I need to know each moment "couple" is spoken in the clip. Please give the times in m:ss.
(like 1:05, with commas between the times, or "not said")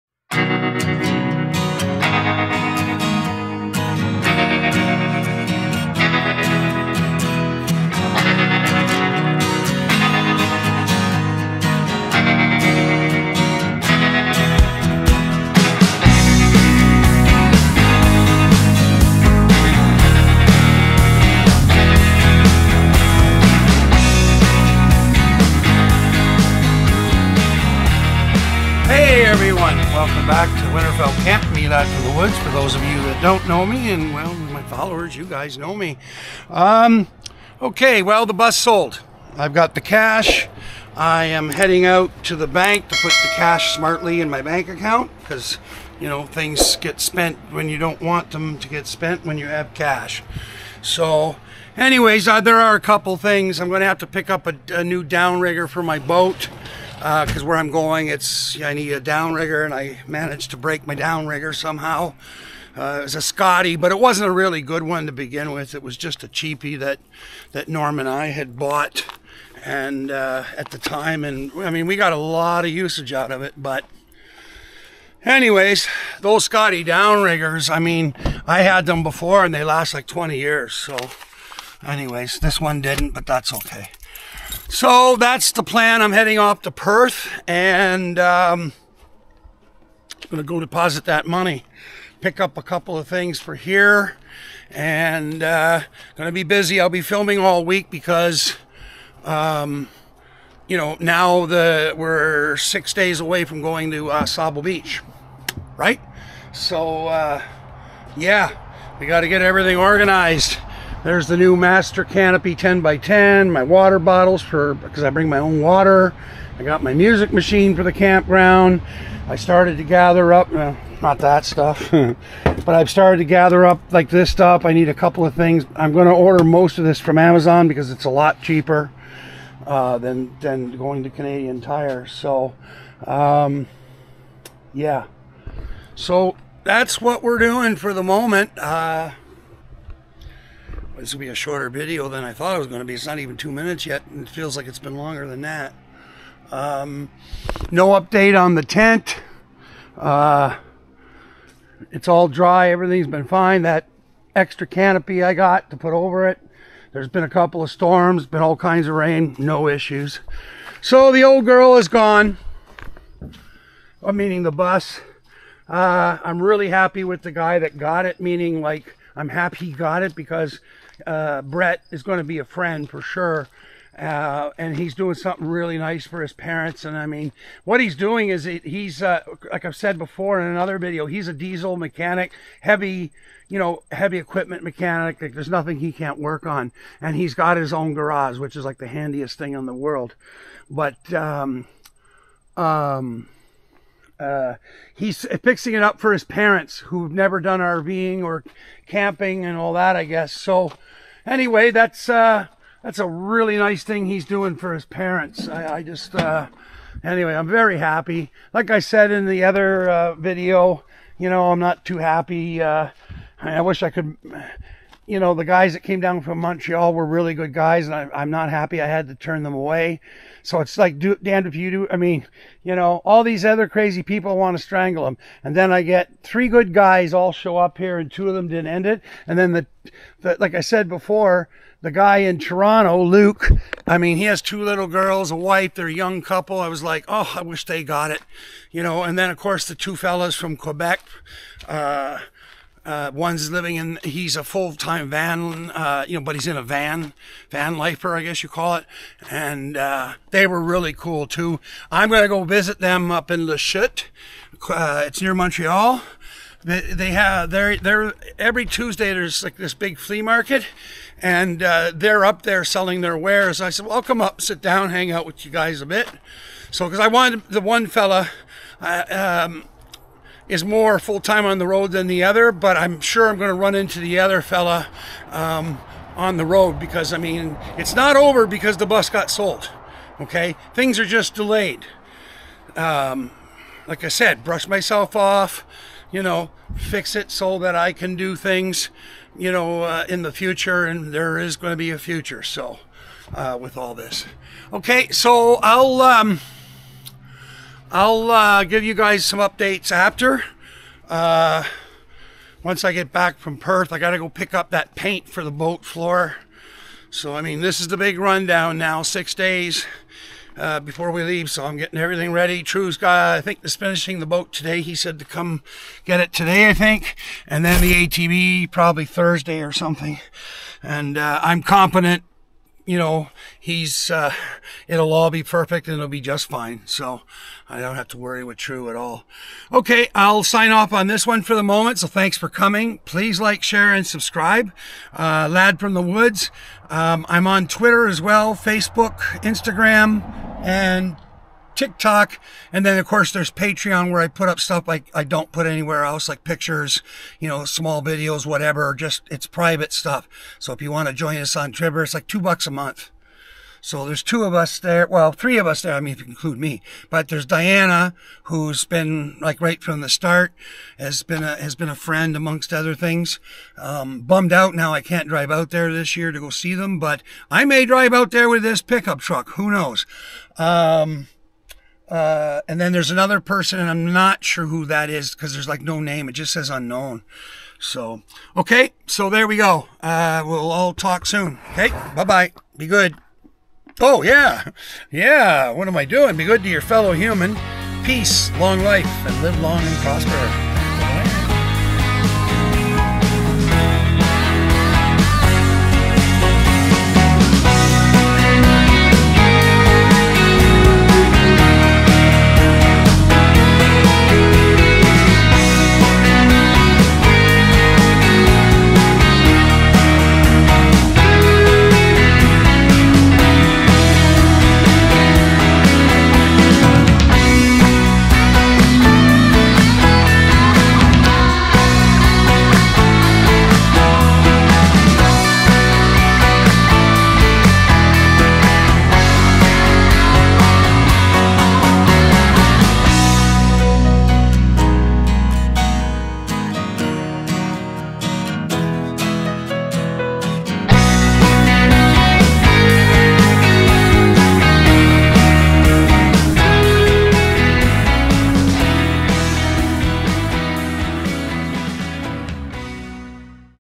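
0:52, 1:32, 2:04, 2:37, 3:56.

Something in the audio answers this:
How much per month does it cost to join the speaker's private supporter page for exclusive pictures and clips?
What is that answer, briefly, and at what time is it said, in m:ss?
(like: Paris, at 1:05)
2 dollars, at 5:52.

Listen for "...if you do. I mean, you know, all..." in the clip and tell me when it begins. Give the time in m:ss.
3:41.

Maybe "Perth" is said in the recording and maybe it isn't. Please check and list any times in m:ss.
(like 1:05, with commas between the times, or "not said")
1:26, 5:03.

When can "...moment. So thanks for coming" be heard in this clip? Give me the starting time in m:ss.
5:31.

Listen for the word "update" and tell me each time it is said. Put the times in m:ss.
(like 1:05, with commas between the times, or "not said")
2:27, 4:59.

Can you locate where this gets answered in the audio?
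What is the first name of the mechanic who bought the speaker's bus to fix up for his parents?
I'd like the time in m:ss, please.
2:51.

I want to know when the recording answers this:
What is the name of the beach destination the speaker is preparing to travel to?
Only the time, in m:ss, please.
1:44.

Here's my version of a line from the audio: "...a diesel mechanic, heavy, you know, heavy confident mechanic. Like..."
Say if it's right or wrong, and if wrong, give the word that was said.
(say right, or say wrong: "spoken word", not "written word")
wrong: "equipment", not "confident".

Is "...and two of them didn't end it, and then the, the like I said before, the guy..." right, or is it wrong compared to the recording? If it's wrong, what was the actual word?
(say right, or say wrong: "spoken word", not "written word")
right.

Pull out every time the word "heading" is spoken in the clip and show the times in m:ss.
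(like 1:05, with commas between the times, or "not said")
0:41, 1:26.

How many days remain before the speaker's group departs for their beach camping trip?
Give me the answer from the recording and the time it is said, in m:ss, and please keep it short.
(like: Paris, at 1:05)
6, at 1:42.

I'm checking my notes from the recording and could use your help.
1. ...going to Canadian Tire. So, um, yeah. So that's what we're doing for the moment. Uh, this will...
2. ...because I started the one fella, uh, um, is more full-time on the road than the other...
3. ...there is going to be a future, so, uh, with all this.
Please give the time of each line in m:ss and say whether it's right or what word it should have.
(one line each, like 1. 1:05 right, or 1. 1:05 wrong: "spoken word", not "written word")
1. 2:10 right
2. 4:26 wrong: "wanted", not "started"
3. 4:51 right.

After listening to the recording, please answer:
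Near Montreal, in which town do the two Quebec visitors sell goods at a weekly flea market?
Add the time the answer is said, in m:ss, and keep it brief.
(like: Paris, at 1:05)
Lachute, at 4:13.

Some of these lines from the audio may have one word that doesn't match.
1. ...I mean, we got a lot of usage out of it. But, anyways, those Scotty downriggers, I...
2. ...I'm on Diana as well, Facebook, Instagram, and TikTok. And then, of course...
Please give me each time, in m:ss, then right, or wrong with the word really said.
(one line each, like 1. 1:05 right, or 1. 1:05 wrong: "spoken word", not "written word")
1. 1:11 right
2. 5:37 wrong: "Twitter", not "Diana".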